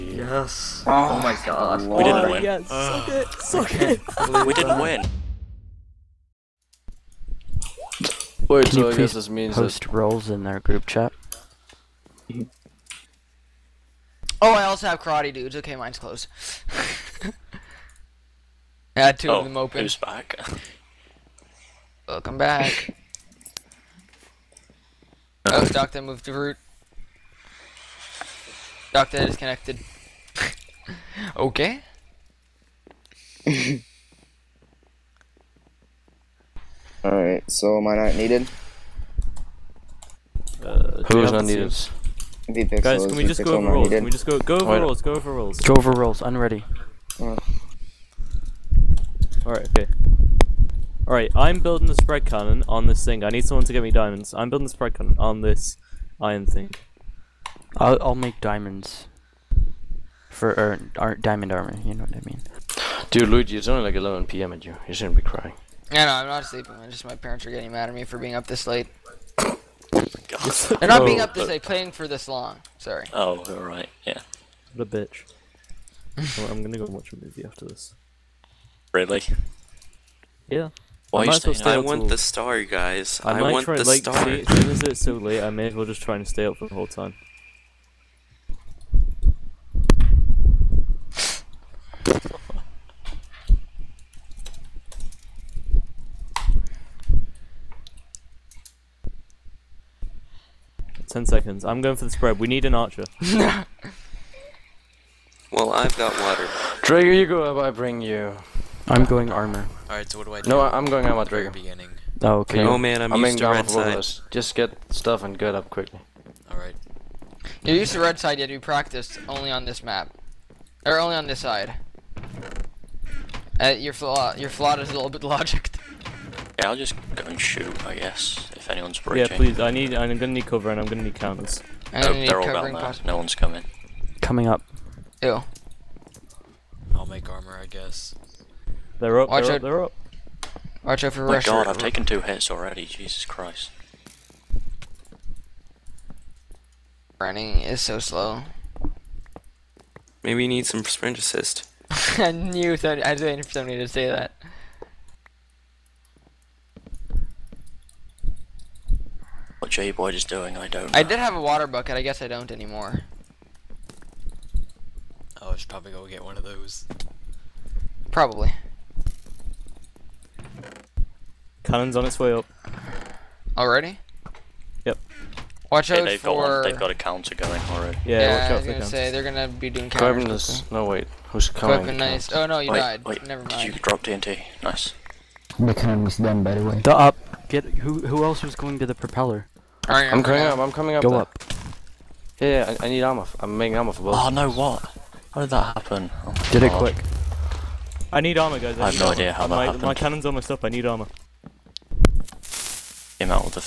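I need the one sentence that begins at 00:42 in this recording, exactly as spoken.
Guys, can we just go over rules?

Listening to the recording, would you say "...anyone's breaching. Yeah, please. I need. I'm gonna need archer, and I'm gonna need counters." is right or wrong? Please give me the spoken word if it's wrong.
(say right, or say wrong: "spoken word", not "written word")
wrong: "cover", not "archer".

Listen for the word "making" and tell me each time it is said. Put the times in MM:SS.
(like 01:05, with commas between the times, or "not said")
03:13.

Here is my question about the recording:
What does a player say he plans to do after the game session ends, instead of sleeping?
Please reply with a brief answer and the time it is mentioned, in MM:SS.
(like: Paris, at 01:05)
watch a movie, at 01:16.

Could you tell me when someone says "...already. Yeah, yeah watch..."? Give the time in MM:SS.
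02:57.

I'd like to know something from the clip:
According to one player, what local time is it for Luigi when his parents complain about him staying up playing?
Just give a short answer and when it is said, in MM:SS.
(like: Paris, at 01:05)
11 p.m., at 01:03.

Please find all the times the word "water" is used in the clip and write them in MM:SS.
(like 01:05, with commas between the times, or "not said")
01:46, 02:41.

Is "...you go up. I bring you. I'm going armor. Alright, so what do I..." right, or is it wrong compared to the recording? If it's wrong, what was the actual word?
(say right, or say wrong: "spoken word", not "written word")
right.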